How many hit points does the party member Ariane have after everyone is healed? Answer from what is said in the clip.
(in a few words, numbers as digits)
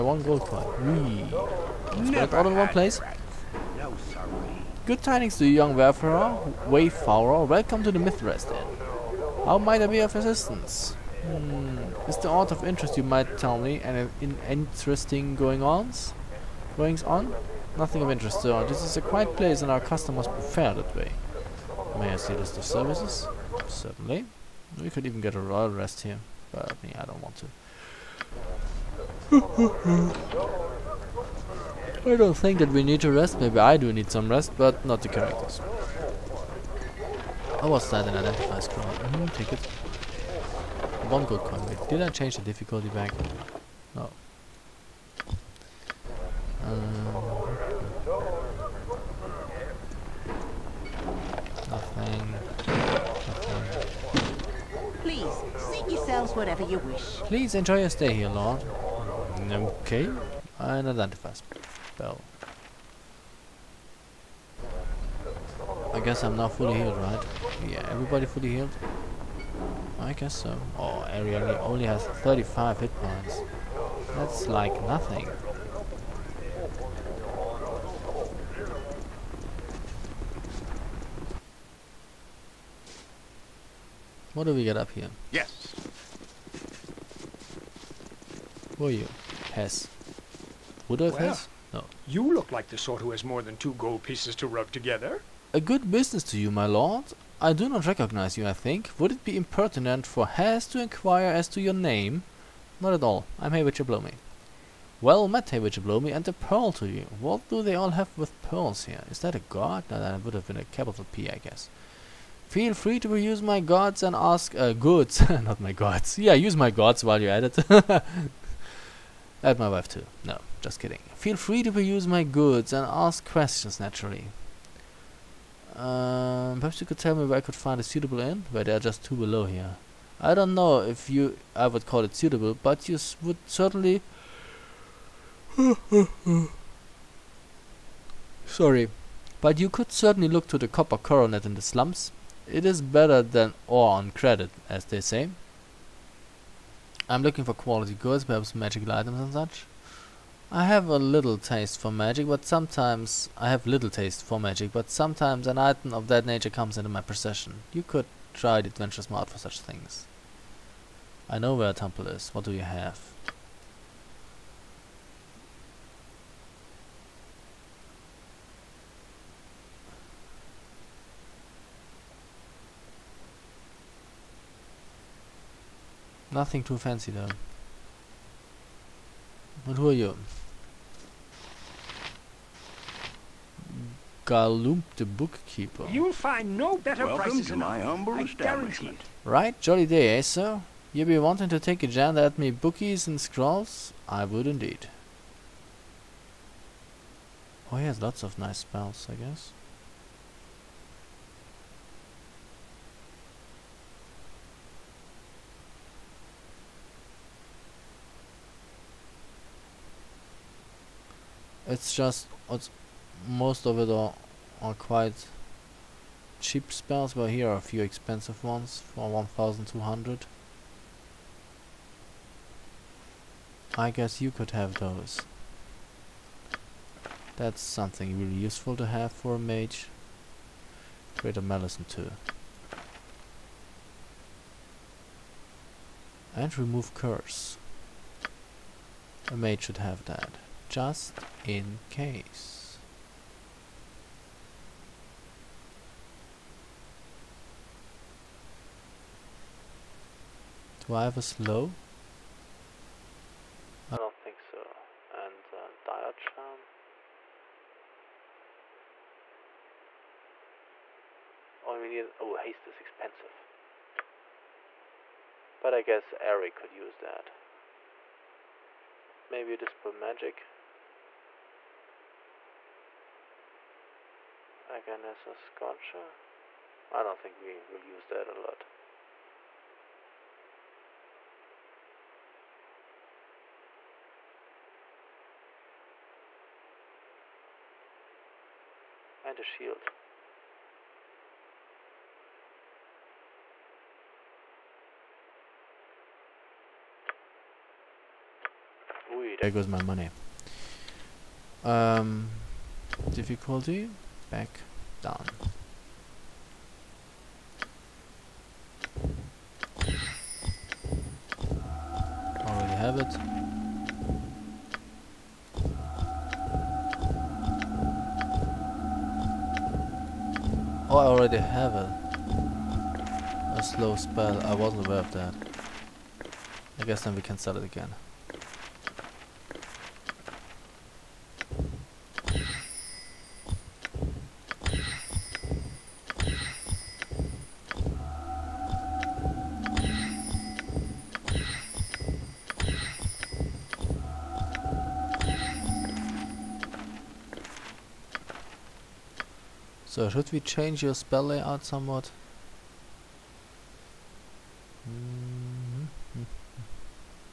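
35.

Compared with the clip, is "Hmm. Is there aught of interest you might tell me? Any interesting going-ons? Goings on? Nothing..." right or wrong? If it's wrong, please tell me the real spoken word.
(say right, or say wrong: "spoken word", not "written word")
right.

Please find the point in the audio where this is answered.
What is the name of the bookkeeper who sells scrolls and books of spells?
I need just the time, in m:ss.
3:04.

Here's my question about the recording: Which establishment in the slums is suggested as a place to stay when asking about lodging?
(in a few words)
Copper Coronet.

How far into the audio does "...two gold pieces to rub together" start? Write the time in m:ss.
1:33.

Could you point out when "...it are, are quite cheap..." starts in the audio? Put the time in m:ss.
3:33.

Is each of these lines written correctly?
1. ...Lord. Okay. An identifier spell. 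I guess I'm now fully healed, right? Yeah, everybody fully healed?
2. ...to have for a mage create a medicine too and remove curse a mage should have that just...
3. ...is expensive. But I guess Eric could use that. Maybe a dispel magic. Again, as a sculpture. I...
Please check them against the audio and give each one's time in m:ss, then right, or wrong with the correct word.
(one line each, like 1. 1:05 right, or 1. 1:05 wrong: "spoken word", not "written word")
1. 0:58 right
2. 3:48 right
3. 4:22 right.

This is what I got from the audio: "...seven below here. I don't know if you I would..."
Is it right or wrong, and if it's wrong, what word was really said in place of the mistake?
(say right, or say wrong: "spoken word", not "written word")
wrong: "two", not "seven".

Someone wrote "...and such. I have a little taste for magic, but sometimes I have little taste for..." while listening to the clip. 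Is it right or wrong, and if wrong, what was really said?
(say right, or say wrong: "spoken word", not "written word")
right.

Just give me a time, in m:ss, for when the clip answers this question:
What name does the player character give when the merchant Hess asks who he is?
1:43.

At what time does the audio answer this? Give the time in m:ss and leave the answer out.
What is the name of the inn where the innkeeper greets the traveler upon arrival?
0:07.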